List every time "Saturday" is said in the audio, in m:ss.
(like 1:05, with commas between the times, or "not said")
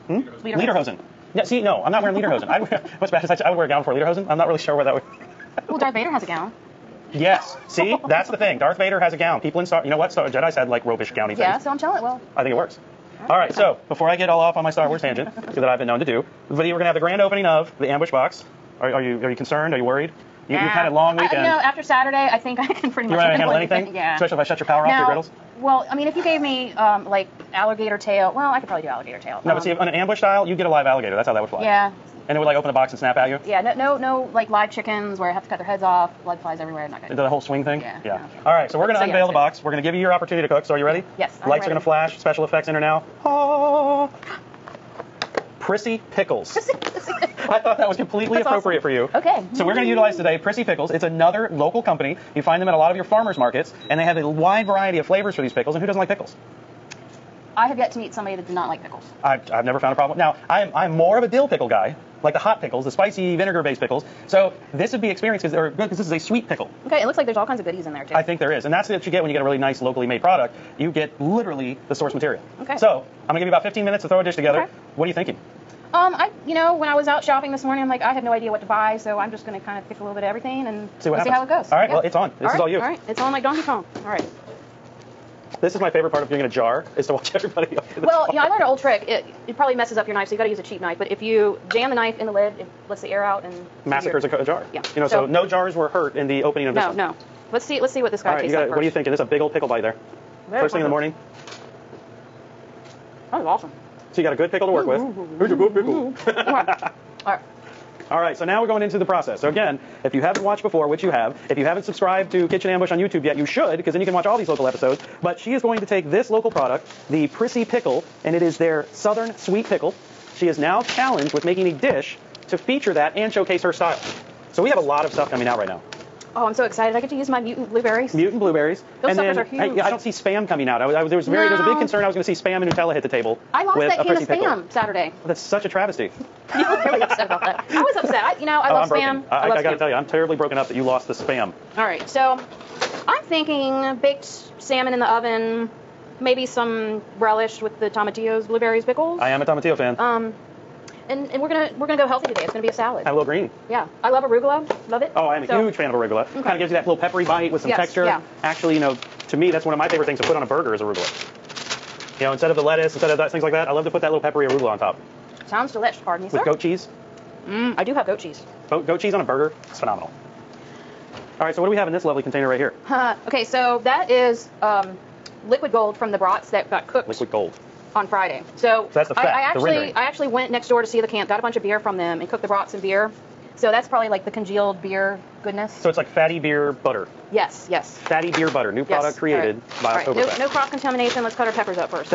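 0:21, 2:14.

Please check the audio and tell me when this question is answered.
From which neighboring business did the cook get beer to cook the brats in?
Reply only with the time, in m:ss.
3:00.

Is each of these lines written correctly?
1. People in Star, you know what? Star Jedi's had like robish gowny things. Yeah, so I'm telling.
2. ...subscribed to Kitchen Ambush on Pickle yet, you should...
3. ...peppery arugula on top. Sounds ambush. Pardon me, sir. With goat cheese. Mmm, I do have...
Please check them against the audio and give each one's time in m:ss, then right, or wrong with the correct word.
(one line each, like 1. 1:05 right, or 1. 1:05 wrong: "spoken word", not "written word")
1. 0:09 right
2. 1:51 wrong: "YouTube", not "Pickle"
3. 2:44 wrong: "delish", not "ambush".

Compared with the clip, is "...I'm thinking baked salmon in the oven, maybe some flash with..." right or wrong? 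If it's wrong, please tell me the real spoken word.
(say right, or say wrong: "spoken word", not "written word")
wrong: "relish", not "flash".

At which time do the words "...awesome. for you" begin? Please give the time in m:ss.
0:48.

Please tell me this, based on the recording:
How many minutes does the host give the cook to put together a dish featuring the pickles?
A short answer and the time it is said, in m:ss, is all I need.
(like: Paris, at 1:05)
15, at 1:13.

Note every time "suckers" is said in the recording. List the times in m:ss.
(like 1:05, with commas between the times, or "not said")
2:09.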